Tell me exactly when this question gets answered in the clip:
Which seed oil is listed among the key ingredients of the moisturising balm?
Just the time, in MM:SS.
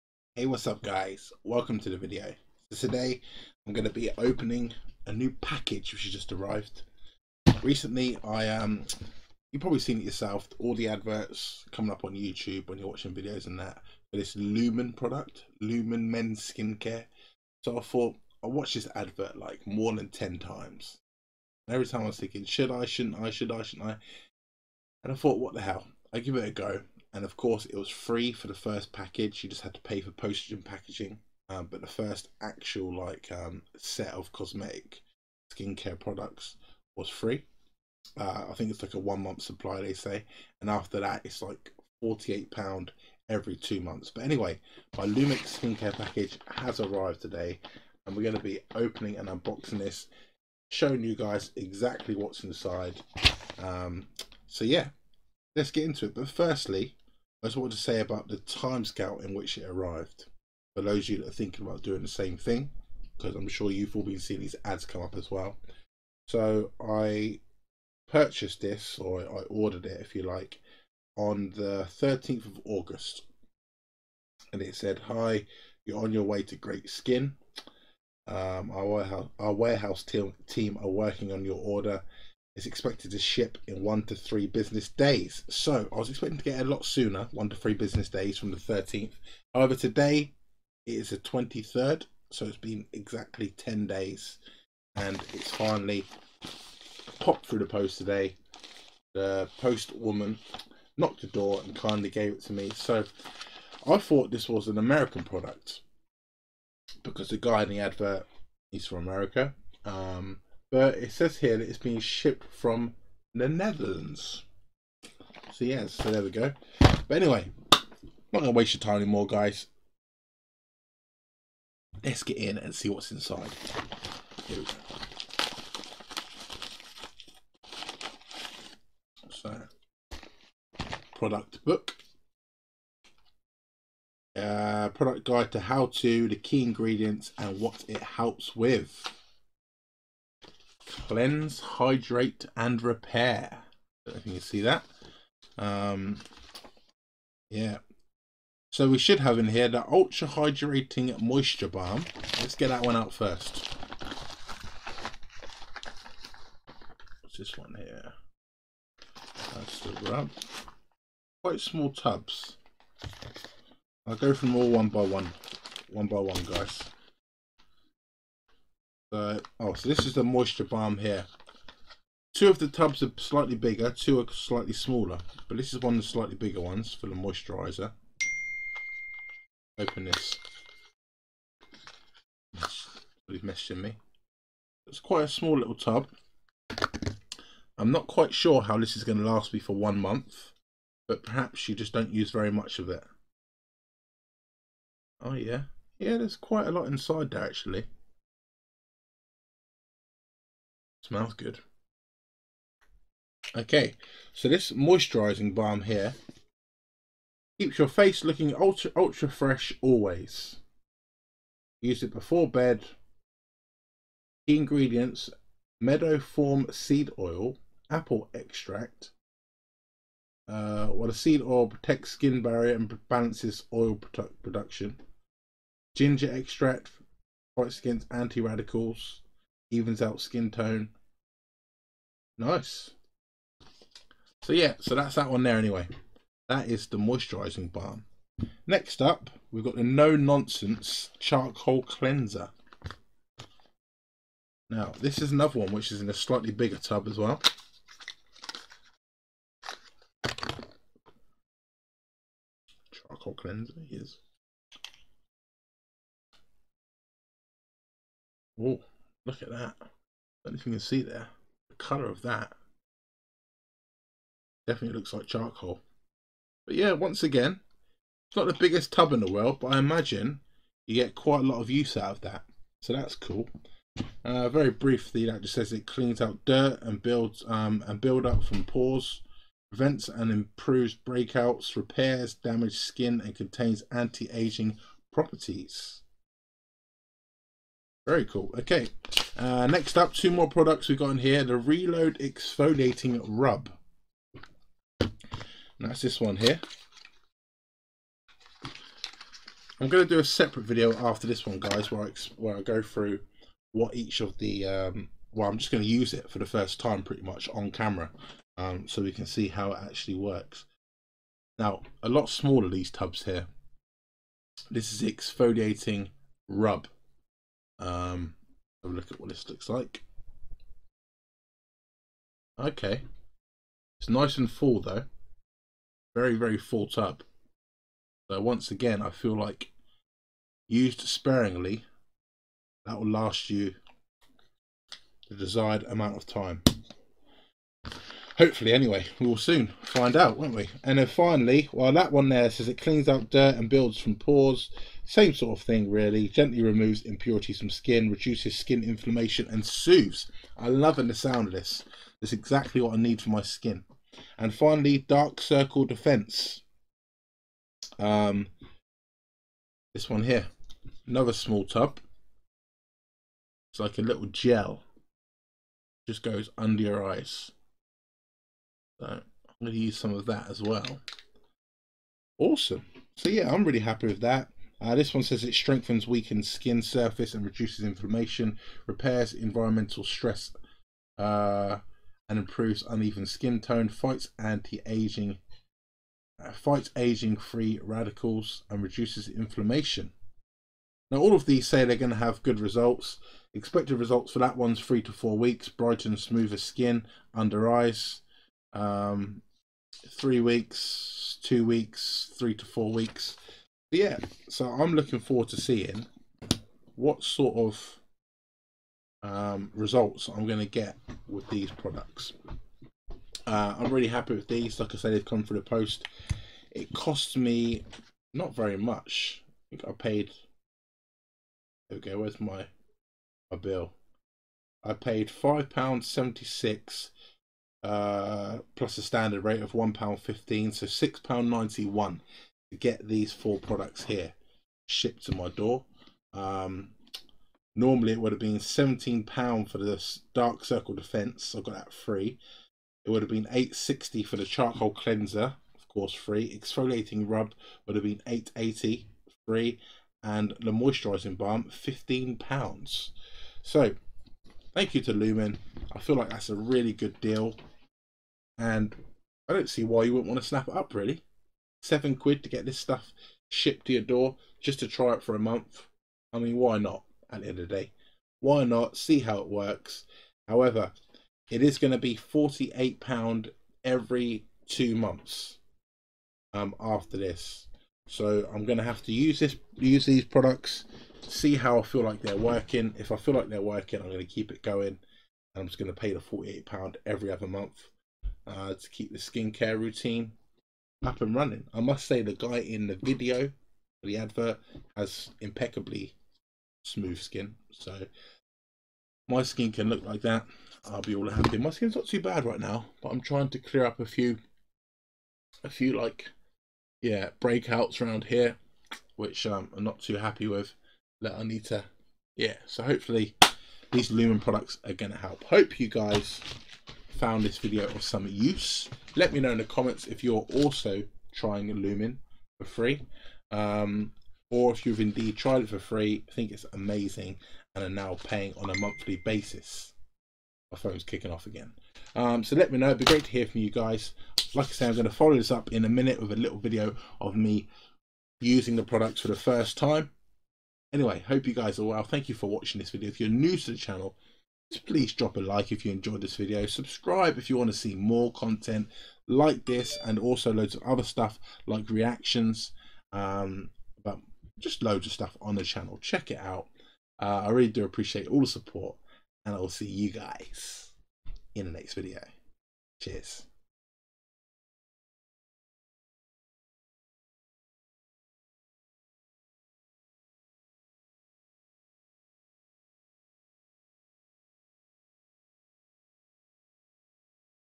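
03:35.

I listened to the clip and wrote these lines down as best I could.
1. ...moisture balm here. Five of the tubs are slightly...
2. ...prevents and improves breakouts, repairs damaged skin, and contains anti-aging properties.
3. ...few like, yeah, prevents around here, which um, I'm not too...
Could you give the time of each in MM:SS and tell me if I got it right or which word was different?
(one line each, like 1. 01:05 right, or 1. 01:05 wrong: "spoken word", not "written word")
1. 02:50 wrong: "Two", not "Five"
2. 04:39 right
3. 08:25 wrong: "breakouts", not "prevents".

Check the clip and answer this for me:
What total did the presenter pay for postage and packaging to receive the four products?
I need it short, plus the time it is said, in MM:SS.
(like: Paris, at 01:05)
£6.91, at 07:10.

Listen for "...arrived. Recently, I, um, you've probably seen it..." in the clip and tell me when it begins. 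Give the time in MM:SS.
00:06.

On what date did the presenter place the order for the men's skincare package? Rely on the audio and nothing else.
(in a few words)
13th of August.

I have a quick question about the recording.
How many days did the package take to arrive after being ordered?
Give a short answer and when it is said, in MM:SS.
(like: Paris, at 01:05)
10, at 01:33.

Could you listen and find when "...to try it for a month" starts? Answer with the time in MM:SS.
07:44.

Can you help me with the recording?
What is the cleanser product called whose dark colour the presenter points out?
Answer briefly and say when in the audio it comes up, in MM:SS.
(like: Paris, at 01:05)
No Nonsense Charcoal Cleanser, at 03:59.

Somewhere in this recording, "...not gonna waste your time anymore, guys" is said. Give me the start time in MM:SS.
01:58.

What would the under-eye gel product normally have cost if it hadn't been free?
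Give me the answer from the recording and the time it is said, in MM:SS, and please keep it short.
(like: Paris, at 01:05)
£17, at 07:18.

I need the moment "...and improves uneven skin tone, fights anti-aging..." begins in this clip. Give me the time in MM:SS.
06:22.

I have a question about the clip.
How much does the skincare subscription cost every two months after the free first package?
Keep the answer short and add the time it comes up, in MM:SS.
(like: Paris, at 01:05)
£48, at 00:42.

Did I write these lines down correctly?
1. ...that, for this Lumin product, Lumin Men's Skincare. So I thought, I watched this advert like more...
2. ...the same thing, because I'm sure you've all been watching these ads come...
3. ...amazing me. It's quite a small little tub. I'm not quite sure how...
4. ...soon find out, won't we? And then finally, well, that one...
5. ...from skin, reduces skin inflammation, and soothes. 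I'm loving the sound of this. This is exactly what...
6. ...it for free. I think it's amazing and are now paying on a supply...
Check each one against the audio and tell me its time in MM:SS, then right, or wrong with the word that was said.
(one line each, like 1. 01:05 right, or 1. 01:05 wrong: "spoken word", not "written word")
1. 00:13 right
2. 01:02 wrong: "seeing", not "watching"
3. 03:03 wrong: "messaging", not "amazing"
4. 05:39 right
5. 05:47 right
6. 08:45 wrong: "monthly", not "supply".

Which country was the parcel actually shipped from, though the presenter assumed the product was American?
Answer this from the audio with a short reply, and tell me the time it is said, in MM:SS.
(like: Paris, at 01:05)
Netherlands, at 01:53.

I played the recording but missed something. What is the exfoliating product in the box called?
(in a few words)
Reload Exfoliating Rub.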